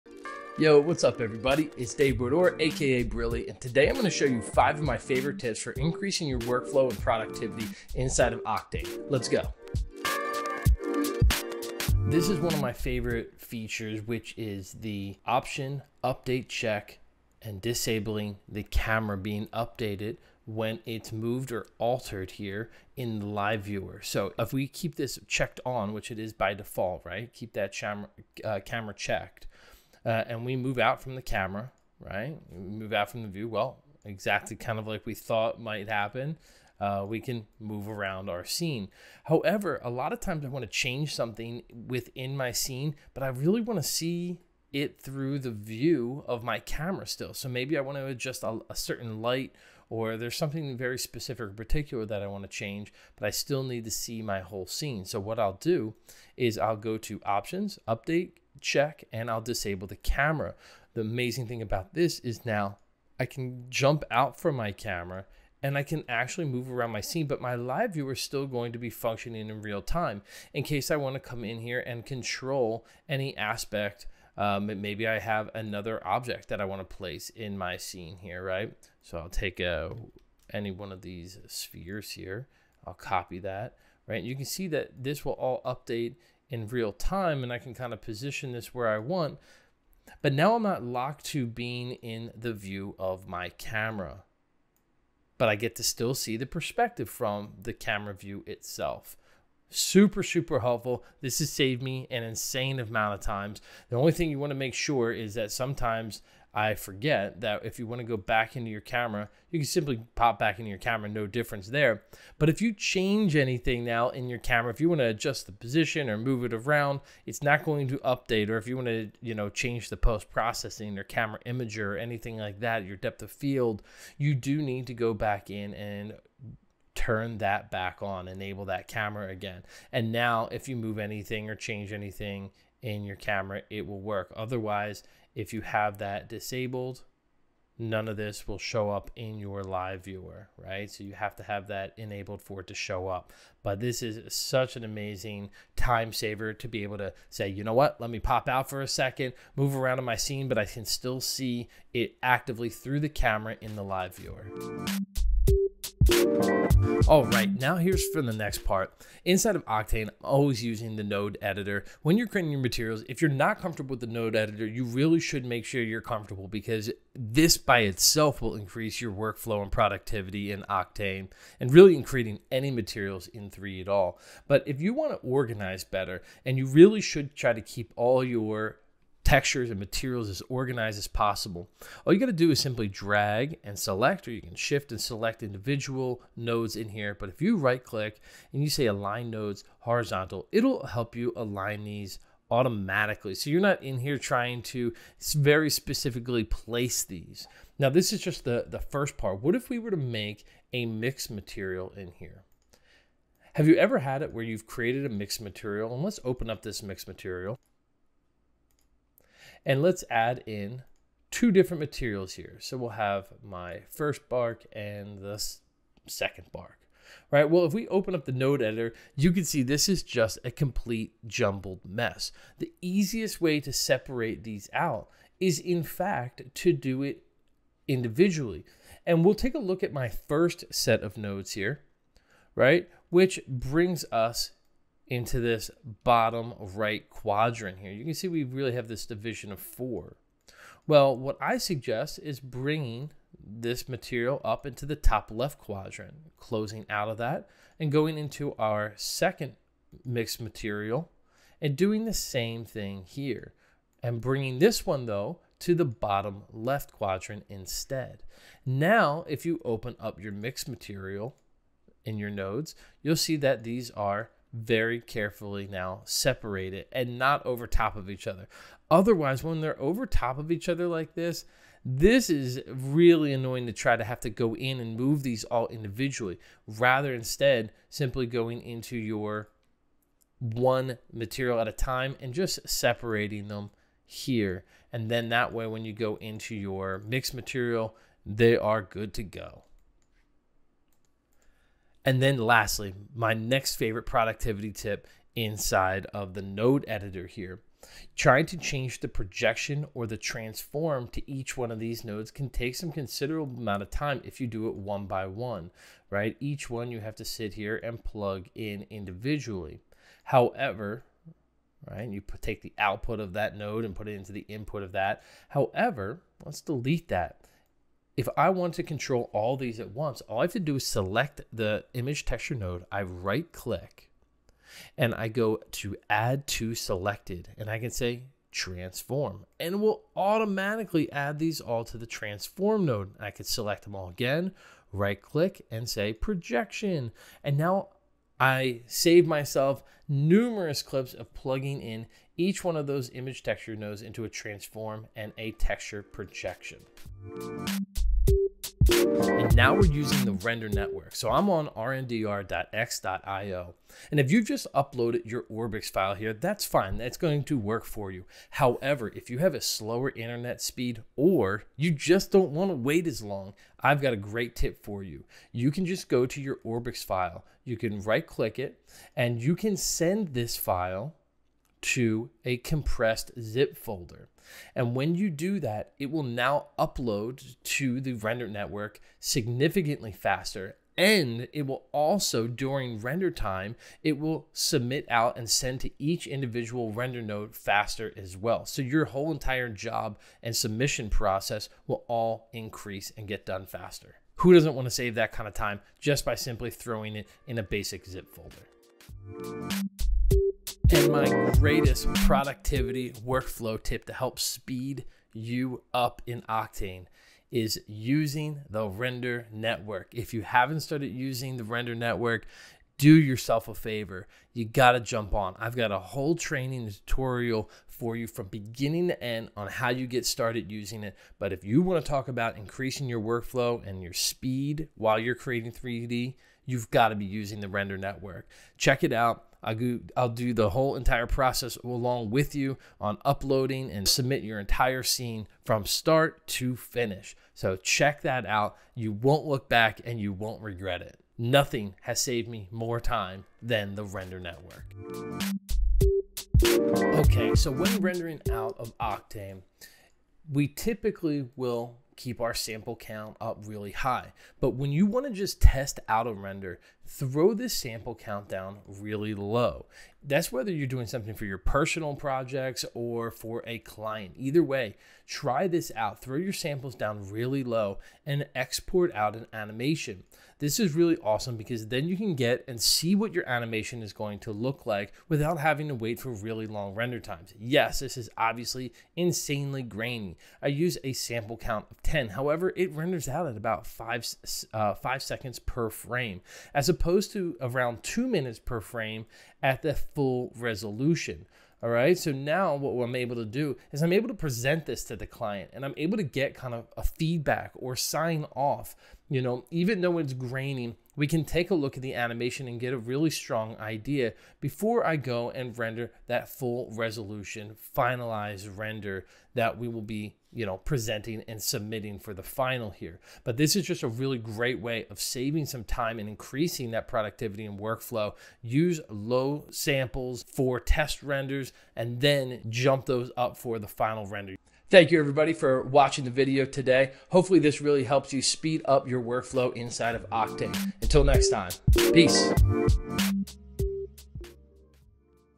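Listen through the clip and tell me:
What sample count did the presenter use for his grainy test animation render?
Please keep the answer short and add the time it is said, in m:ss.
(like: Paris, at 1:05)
10, at 8:02.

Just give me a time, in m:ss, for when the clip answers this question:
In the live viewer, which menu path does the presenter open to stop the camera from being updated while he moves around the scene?
0:57.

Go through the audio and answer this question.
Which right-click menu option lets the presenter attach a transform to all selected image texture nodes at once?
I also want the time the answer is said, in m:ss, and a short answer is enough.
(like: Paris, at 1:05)
Add to selected, at 5:26.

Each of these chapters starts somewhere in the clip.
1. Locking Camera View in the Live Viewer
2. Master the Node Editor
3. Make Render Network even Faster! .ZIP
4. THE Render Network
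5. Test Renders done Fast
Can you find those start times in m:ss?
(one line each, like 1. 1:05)
1. 0:10
2. 2:35
3. 5:48
4. 6:40
5. 7:25.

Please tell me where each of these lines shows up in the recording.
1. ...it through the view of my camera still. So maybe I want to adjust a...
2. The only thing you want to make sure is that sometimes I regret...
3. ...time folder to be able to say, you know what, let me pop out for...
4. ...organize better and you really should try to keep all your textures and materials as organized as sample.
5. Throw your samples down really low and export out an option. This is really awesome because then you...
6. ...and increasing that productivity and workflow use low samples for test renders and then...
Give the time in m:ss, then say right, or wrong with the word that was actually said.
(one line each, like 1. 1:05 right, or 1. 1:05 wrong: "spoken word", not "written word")
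1. 0:44 right
2. 1:43 wrong: "forget", not "regret"
3. 2:25 wrong: "saver", not "folder"
4. 2:55 wrong: "possible", not "sample"
5. 7:46 wrong: "animation", not "option"
6. 8:36 right.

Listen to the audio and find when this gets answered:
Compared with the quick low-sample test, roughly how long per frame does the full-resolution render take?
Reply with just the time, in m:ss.
8:08.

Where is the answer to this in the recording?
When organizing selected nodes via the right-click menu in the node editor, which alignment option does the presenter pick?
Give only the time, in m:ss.
3:08.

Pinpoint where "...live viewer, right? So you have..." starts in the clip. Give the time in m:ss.
2:19.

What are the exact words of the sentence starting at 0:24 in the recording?
So if we keep this checked on, which it is by default, right?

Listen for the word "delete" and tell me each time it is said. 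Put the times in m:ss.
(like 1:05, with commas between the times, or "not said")
5:16.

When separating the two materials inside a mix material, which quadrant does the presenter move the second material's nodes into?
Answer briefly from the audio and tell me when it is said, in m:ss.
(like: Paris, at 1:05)
Bottom left, at 4:15.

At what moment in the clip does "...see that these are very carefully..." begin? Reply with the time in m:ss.
4:23.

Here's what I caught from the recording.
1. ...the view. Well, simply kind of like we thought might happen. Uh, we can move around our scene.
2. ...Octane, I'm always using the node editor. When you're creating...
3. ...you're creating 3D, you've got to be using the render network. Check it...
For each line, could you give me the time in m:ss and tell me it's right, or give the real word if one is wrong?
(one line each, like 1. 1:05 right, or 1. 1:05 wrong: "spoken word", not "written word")
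1. 0:33 wrong: "exactly", not "simply"
2. 2:39 right
3. 7:05 right.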